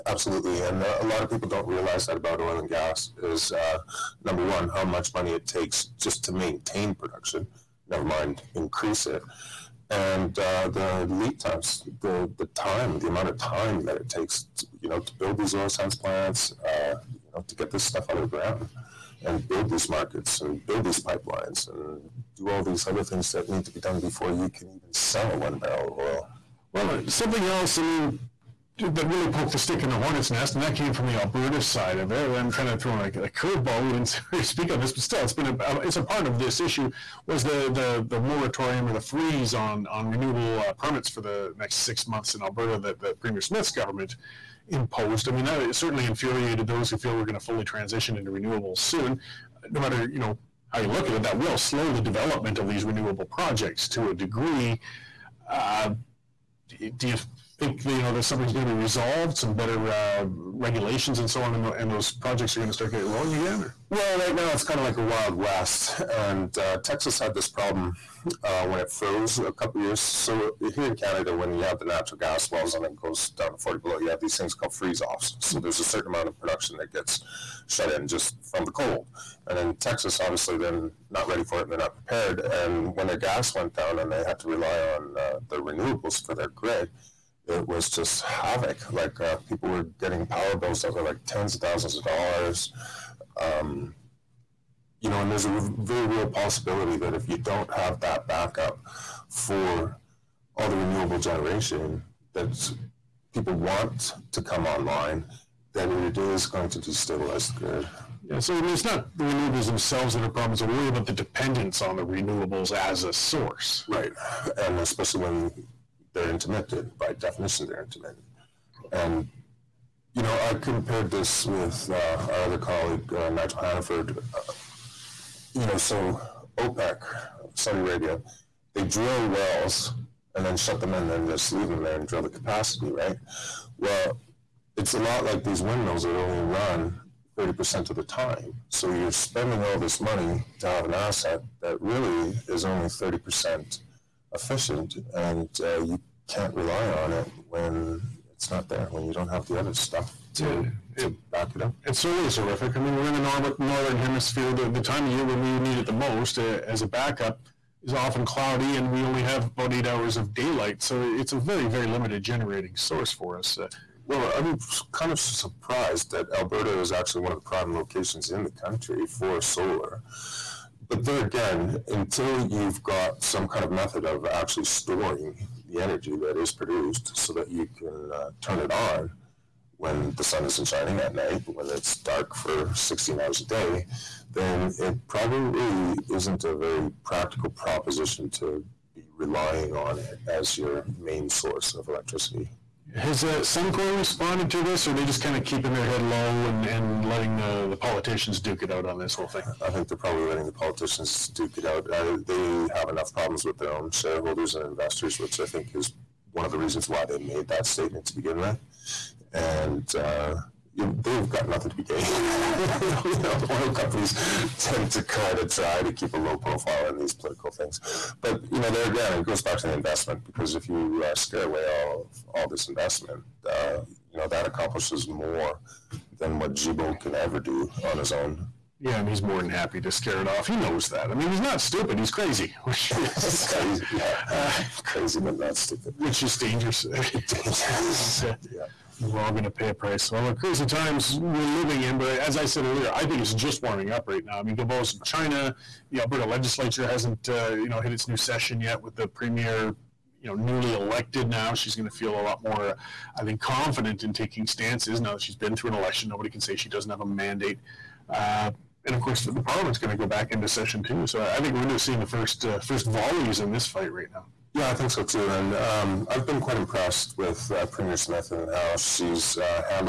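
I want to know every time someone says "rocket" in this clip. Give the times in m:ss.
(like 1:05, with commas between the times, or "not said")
not said.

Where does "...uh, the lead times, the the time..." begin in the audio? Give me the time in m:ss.
0:10.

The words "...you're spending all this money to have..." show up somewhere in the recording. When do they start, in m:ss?
2:18.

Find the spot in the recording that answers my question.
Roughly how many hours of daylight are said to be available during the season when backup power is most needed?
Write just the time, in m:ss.
2:39.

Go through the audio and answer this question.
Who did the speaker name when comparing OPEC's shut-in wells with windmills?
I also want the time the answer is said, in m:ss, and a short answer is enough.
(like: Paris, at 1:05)
Nigel Hannaford, at 2:03.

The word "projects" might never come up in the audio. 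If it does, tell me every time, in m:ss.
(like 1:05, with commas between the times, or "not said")
0:53, 1:02.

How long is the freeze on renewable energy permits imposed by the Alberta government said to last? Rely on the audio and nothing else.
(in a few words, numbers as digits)
6 months.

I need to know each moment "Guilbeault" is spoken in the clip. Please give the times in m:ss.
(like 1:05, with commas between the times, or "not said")
3:46, 4:04.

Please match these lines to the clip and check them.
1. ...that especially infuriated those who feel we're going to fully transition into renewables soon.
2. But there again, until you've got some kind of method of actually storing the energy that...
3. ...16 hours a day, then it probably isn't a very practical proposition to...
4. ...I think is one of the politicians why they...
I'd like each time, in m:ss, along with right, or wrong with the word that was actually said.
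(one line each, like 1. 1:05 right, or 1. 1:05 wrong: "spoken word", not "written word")
1. 0:45 wrong: "certainly", not "especially"
2. 2:50 right
3. 3:02 right
4. 3:25 wrong: "reasons", not "politicians".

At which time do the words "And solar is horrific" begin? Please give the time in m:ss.
2:31.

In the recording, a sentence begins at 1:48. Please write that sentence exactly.
Yeah, so I mean, it's not the renewables themselves that are problems.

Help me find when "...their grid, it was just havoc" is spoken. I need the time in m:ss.
1:26.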